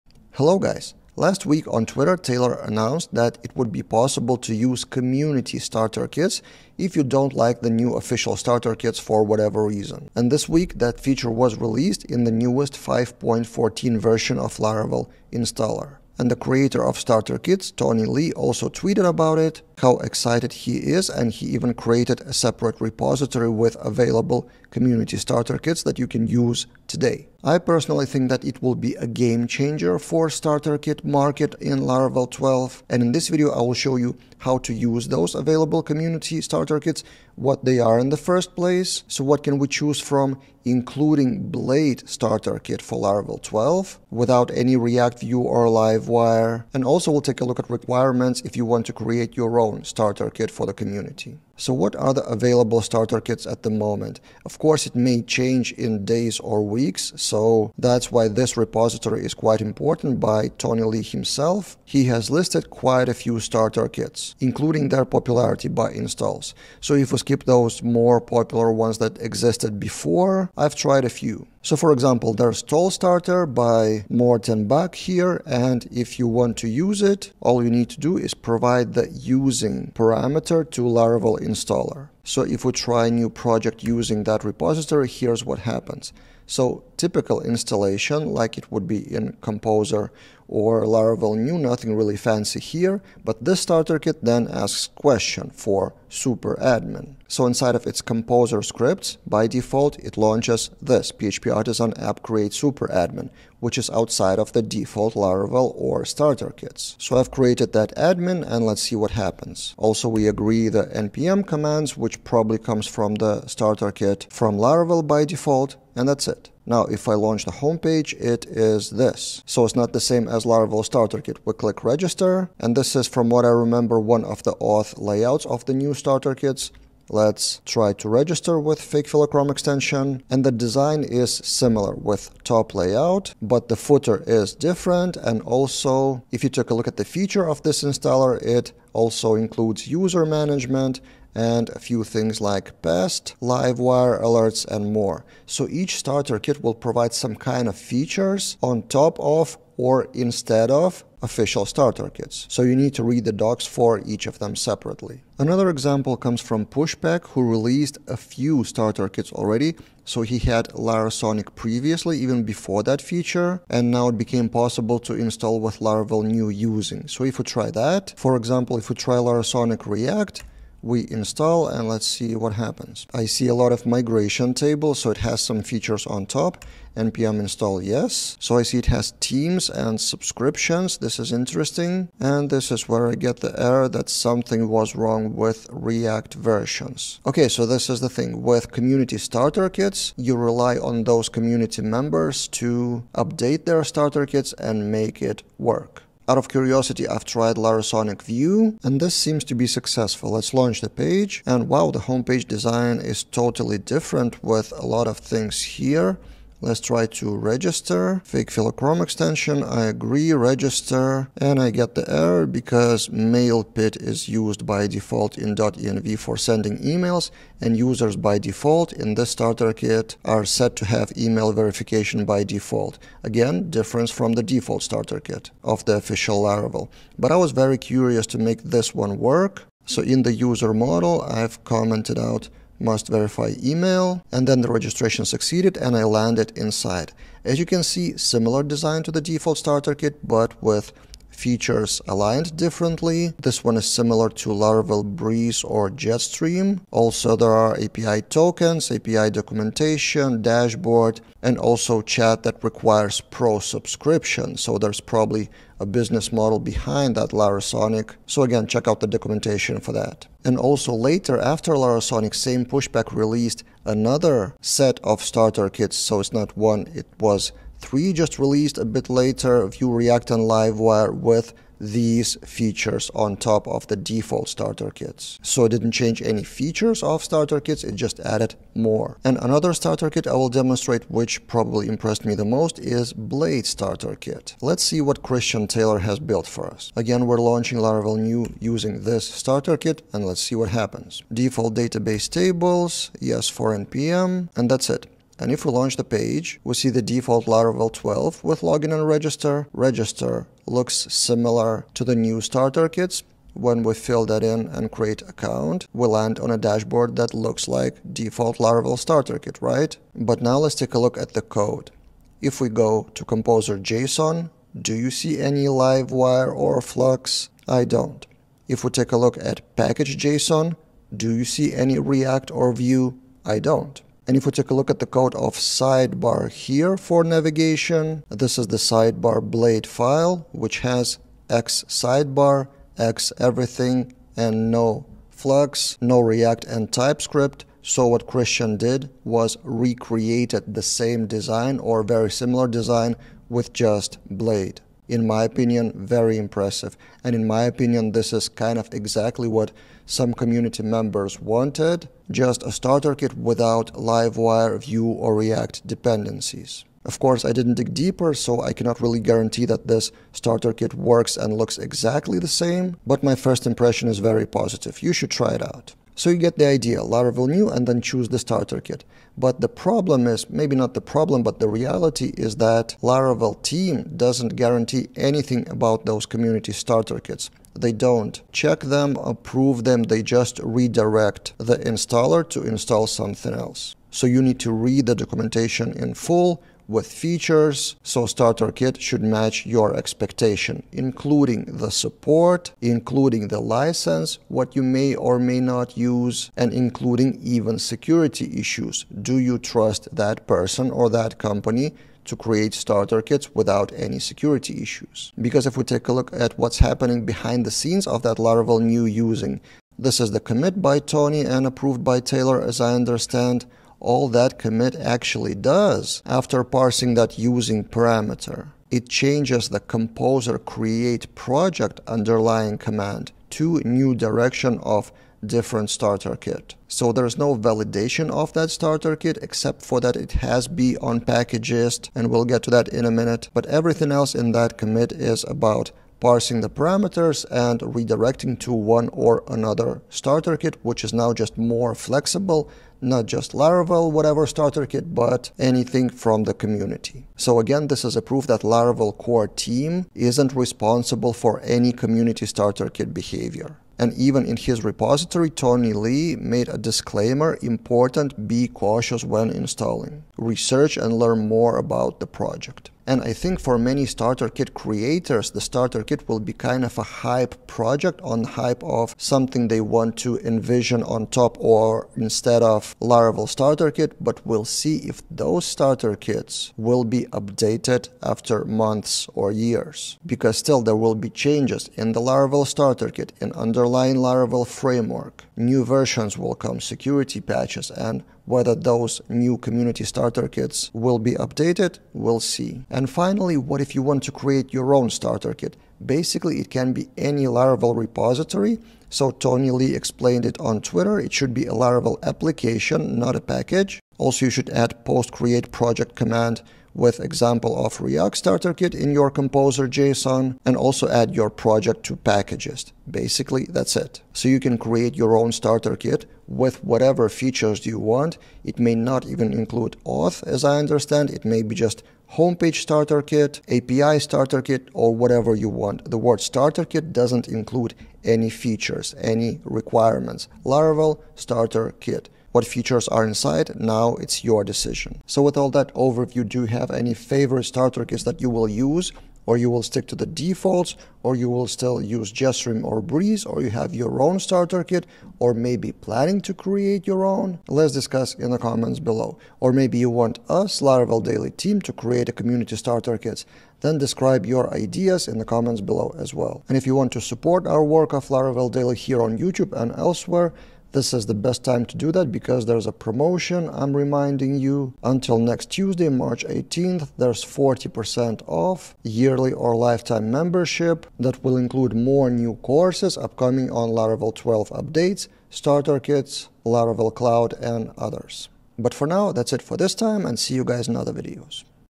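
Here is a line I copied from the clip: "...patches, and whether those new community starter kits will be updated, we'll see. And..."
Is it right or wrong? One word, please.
right.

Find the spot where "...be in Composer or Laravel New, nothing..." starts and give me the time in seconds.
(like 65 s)
88 s.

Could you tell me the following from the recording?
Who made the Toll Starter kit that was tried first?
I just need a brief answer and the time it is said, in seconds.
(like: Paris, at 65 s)
Morten Bach, at 74 s.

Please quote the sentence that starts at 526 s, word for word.
The word starter kit doesn't include any features, any requirements.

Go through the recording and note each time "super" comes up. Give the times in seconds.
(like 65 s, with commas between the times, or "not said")
96 s, 102 s.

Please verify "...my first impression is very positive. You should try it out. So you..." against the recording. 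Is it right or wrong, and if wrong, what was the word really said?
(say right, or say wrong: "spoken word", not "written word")
right.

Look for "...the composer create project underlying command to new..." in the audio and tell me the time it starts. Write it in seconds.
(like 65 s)
419 s.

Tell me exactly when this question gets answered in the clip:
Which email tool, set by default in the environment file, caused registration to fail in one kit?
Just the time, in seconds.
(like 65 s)
213 s.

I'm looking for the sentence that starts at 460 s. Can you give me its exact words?
Research and learn more about the project.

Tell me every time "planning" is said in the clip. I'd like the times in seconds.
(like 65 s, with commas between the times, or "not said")
545 s.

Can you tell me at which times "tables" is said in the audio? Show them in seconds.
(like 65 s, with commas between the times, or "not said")
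174 s, 292 s.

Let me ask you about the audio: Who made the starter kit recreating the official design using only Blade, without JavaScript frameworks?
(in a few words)
Christian Taylor.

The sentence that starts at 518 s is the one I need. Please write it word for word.
It may not even include auth, as I understand.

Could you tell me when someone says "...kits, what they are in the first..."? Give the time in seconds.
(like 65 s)
36 s.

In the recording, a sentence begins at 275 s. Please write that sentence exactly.
So it didn't change any features of starter kits, it just added more.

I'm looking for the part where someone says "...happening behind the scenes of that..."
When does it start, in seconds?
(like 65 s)
406 s.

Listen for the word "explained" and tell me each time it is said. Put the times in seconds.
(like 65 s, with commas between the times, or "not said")
499 s.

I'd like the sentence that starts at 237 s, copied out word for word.
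As you can see, similar design to the default starter kit, but with features aligned differently.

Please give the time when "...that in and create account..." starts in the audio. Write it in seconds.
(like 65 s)
304 s.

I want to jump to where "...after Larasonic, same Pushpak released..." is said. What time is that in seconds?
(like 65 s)
261 s.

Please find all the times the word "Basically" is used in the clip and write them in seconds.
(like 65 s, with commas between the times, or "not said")
496 s, 513 s.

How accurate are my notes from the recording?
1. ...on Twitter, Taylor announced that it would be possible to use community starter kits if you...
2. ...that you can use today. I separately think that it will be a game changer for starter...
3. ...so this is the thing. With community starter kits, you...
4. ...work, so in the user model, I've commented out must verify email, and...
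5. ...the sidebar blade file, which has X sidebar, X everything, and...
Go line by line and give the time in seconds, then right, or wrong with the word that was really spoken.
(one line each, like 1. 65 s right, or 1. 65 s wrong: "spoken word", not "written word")
1. 1 s right
2. 25 s wrong: "personally", not "separately"
3. 187 s right
4. 229 s right
5. 328 s right.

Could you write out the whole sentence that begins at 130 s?
And the design is similar with top layout, but the footer is different.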